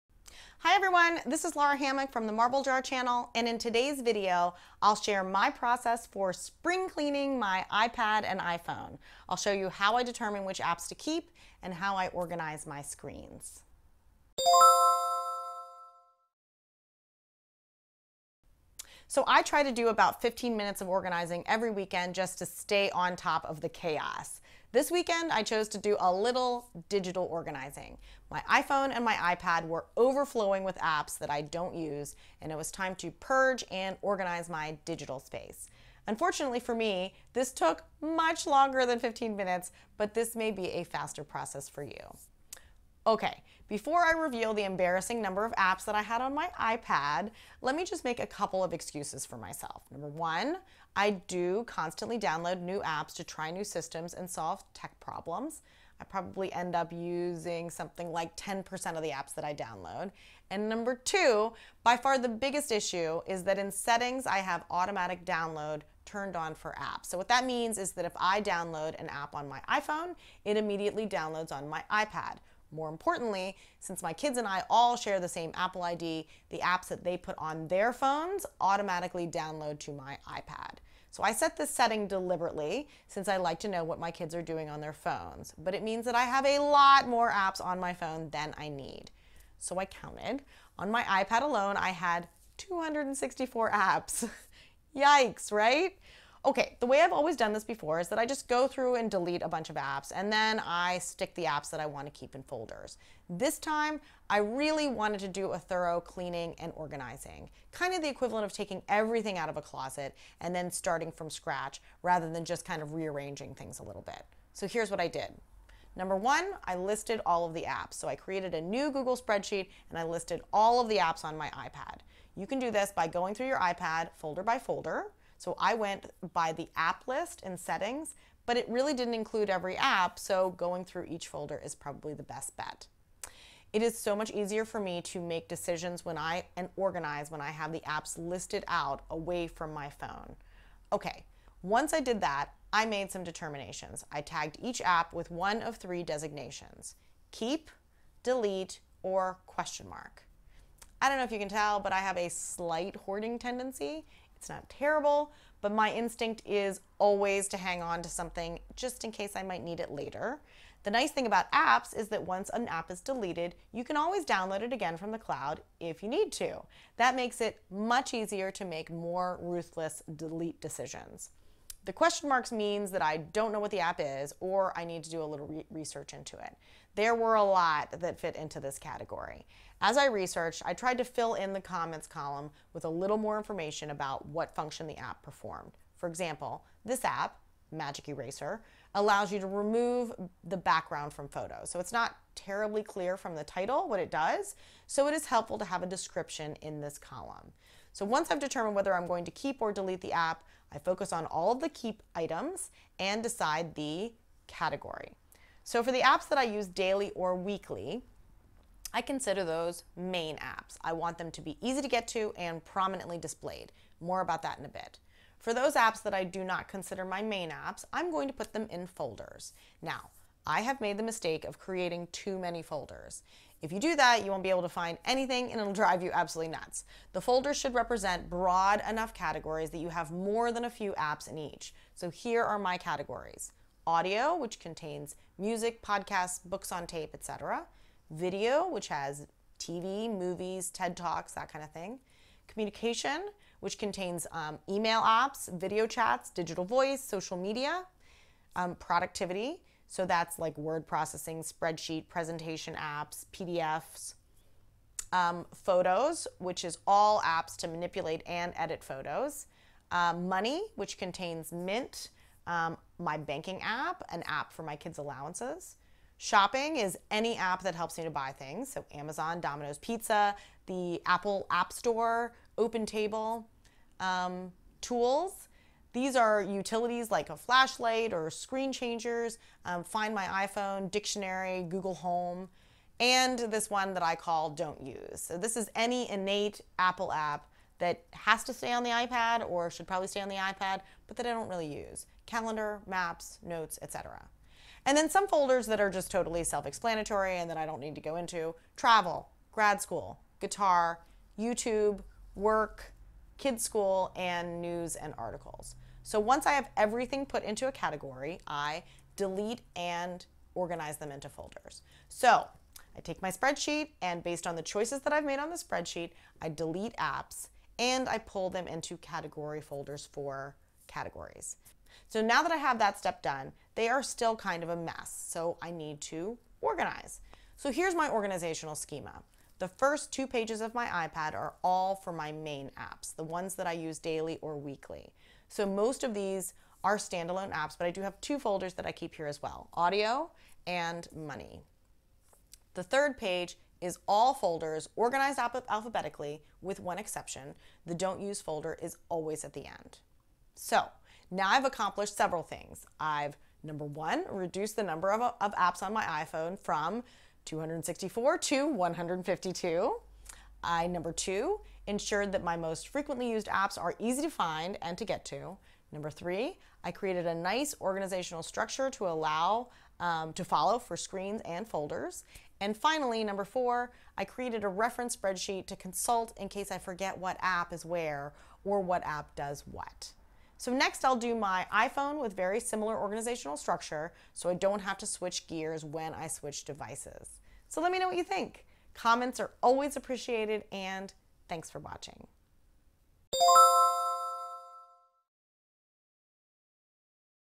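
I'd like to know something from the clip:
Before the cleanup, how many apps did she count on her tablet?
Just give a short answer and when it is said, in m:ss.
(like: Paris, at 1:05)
264, at 1:32.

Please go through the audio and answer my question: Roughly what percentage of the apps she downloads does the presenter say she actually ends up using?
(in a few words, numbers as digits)
10%.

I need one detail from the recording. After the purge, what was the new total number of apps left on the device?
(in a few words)
152.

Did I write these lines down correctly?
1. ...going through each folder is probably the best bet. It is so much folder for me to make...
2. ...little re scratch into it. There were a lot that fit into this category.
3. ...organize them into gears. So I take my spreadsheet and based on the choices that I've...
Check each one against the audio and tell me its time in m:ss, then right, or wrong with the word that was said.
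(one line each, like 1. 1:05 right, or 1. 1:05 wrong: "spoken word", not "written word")
1. 2:10 wrong: "easier", not "folder"
2. 2:55 wrong: "research", not "scratch"
3. 5:10 wrong: "folders", not "gears".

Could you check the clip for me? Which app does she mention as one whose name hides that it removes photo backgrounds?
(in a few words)
Magic Eraser.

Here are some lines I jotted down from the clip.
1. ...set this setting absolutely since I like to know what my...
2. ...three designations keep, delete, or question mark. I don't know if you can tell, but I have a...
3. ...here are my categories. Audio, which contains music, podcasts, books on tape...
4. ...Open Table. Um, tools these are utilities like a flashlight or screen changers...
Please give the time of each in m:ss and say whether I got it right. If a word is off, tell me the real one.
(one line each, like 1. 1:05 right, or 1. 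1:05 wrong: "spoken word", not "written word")
1. 1:21 wrong: "deliberately", not "absolutely"
2. 2:25 right
3. 3:52 right
4. 4:32 right.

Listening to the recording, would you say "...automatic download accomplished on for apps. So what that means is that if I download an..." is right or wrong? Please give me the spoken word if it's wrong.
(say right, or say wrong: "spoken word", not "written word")
wrong: "turned", not "accomplished".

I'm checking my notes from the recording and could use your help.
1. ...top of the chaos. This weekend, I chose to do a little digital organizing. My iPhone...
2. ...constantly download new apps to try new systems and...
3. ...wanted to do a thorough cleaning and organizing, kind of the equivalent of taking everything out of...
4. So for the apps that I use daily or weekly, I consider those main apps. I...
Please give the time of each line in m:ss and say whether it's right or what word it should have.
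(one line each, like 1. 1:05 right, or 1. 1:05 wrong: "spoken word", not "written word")
1. 0:23 right
2. 0:51 right
3. 1:44 right
4. 3:25 right.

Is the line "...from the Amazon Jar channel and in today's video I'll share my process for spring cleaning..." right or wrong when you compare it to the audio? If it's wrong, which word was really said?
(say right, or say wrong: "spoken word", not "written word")
wrong: "Marble", not "Amazon".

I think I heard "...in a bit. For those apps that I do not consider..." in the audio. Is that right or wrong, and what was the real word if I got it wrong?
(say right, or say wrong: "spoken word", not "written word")
right.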